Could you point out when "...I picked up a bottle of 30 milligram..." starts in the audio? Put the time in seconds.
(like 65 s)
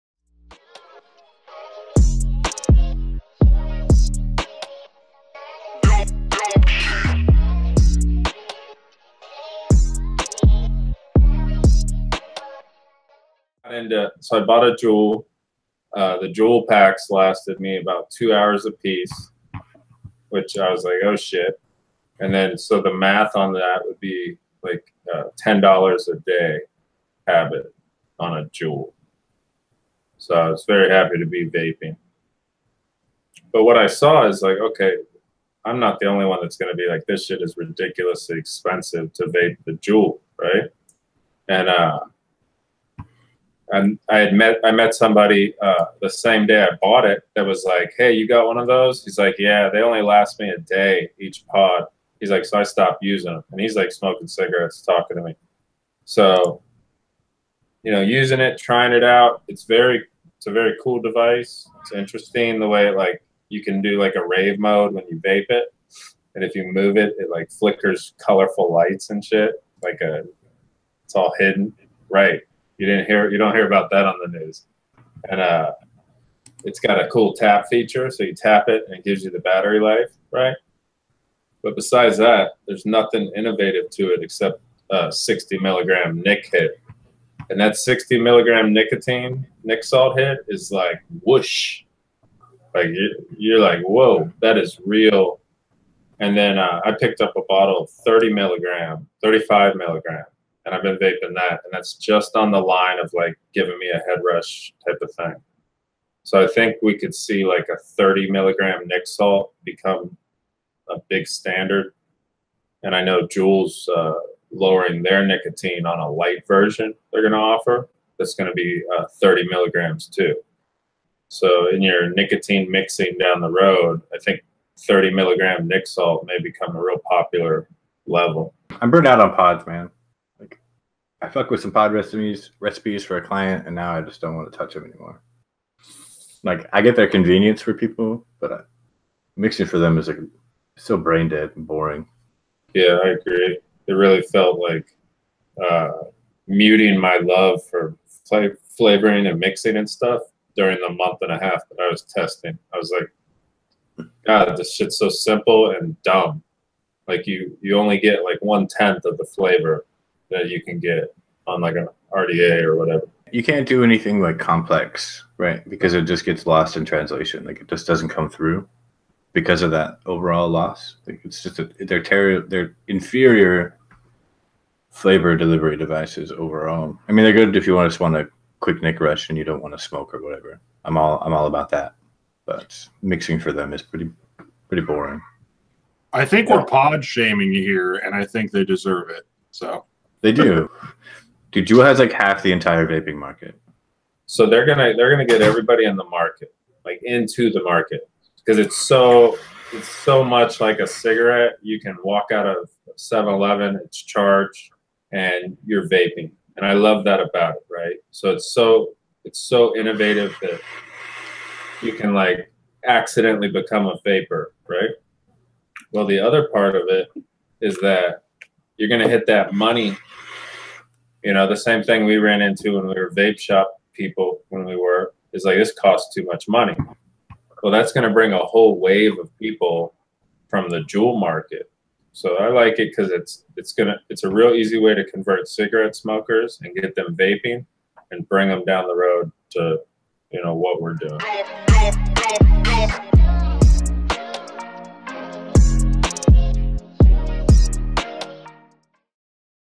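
96 s.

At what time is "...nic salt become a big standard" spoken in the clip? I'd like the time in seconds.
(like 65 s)
108 s.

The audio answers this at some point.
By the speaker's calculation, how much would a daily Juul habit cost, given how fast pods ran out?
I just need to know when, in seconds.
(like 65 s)
25 s.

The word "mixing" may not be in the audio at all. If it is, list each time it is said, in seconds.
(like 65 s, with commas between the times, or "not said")
122 s, 139 s, 149 s, 183 s.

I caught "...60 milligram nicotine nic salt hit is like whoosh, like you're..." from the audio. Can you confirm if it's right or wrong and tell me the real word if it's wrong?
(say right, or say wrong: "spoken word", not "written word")
right.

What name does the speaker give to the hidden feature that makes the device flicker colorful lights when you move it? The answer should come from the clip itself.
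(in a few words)
rave mode.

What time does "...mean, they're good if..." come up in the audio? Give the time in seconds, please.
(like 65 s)
177 s.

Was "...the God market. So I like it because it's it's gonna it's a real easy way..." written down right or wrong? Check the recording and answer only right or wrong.
wrong.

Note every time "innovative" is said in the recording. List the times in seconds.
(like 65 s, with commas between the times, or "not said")
83 s, 209 s.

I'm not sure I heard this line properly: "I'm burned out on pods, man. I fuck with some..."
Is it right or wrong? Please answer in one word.
right.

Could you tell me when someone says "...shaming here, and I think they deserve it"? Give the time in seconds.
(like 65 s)
187 s.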